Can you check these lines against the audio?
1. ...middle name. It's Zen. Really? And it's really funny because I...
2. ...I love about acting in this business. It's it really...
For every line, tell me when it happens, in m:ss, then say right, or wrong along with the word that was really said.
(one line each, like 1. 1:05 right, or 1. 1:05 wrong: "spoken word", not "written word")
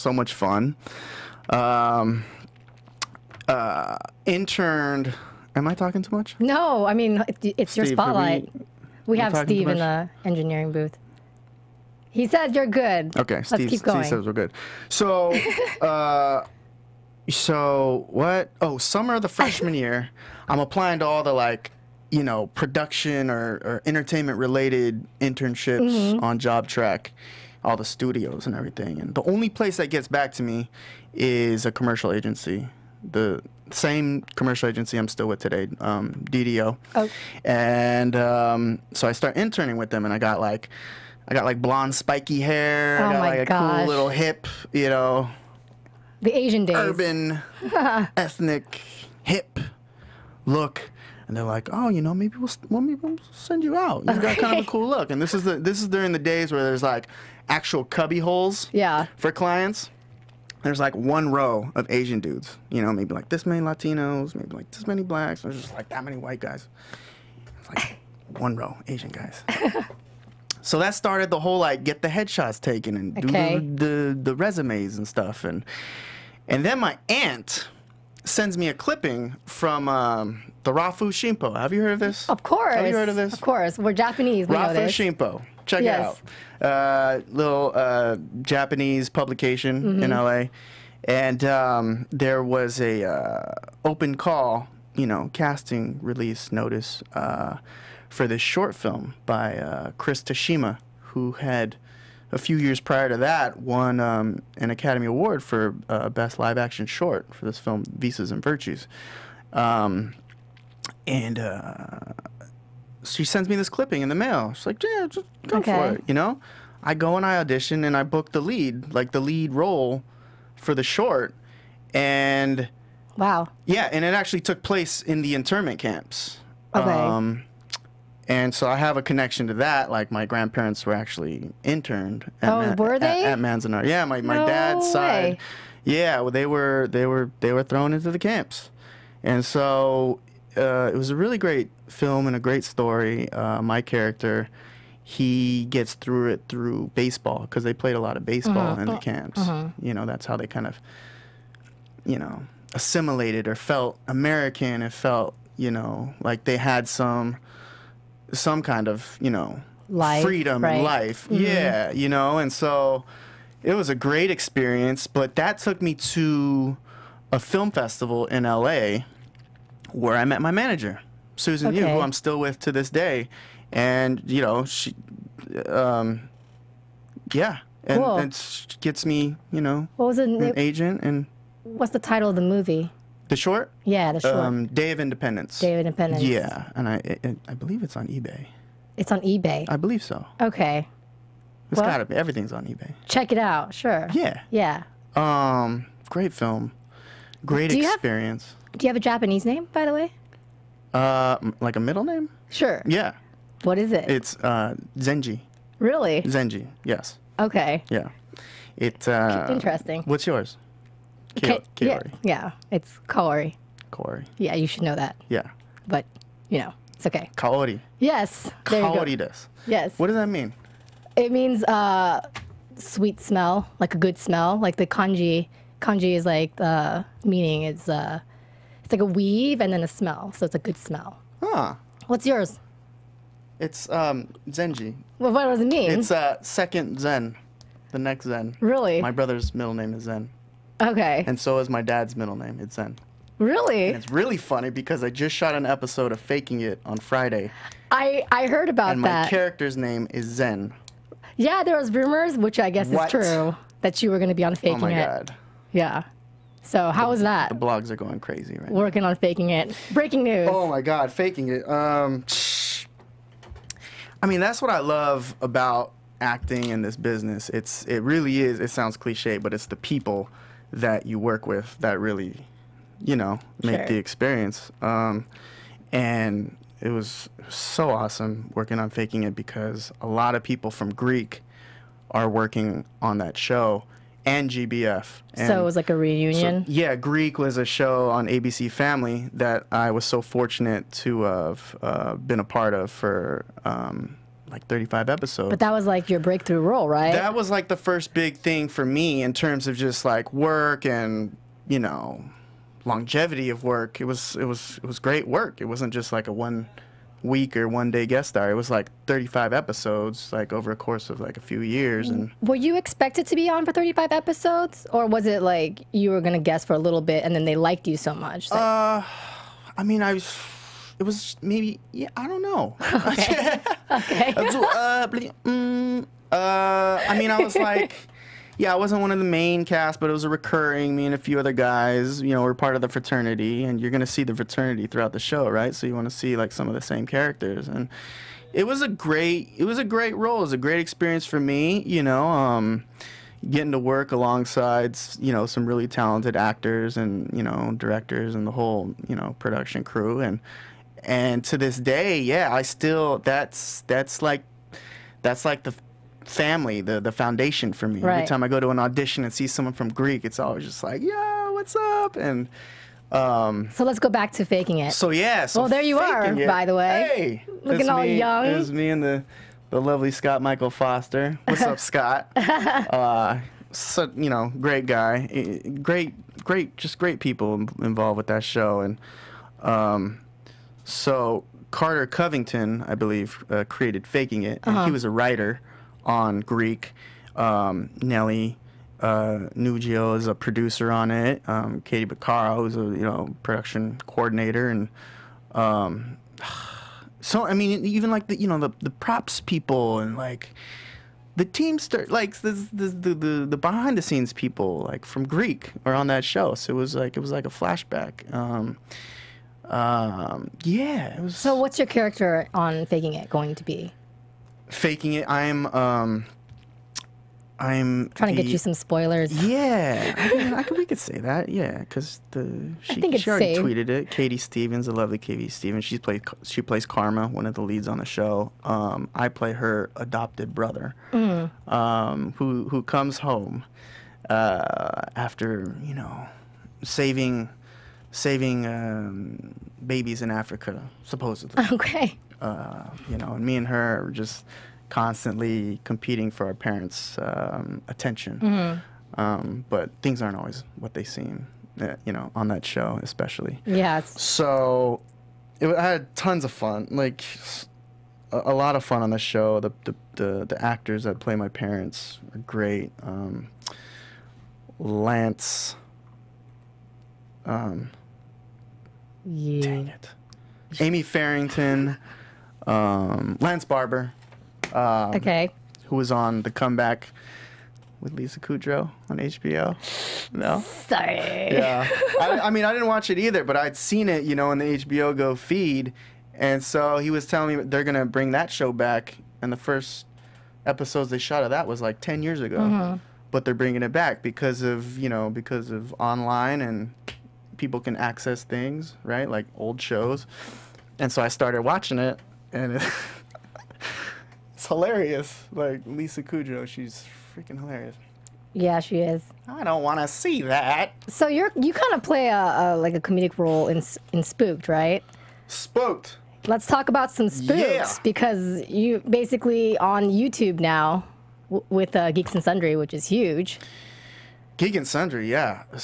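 1. 4:02 right
2. 4:24 right.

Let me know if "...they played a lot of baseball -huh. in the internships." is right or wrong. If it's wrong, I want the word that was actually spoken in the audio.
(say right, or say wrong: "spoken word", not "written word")
wrong: "camps", not "internships".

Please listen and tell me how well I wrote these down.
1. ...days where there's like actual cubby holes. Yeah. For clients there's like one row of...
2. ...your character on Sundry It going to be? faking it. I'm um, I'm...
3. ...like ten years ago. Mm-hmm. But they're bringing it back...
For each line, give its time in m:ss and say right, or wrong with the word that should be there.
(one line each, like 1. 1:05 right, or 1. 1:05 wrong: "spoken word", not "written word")
1. 0:56 right
2. 6:51 wrong: "Faking", not "Sundry"
3. 8:11 right.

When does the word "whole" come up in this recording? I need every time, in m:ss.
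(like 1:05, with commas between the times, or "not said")
1:11, 5:48.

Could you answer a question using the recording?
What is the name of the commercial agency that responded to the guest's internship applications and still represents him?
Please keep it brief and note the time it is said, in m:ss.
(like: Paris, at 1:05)
DDO, at 0:36.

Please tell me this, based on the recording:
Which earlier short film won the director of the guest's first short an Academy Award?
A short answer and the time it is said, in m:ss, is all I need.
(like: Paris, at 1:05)
Visas and Virtues, at 1:47.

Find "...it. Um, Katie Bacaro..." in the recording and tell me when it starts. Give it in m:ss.
6:31.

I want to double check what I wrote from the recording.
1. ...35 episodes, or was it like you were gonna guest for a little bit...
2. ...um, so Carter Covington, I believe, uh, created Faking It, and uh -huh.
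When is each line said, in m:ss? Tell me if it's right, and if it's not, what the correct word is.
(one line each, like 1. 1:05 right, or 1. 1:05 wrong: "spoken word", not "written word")
1. 5:13 right
2. 6:19 right.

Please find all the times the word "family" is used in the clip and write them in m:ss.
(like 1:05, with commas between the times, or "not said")
4:48, 5:56.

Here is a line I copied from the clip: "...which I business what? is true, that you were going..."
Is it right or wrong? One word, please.
wrong.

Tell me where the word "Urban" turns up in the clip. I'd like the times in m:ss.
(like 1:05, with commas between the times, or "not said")
0:46.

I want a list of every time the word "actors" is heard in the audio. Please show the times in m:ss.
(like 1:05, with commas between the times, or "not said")
5:46, 7:40.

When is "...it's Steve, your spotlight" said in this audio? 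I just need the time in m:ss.
0:07.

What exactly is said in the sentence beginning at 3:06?
Yeah, and I, it, I believe it's on eBay.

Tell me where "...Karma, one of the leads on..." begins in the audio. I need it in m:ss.
7:06.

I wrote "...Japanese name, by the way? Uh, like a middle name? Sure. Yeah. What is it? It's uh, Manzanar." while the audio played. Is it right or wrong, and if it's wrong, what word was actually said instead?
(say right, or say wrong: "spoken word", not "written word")
wrong: "Zenji", not "Manzanar".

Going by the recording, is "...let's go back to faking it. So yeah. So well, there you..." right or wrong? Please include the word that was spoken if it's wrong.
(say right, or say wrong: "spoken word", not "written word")
right.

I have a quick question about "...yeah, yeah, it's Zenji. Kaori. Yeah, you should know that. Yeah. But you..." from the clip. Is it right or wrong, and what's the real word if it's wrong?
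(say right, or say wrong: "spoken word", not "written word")
wrong: "Kaori", not "Zenji".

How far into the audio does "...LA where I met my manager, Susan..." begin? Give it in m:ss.
2:48.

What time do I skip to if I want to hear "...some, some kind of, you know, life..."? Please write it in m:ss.
2:36.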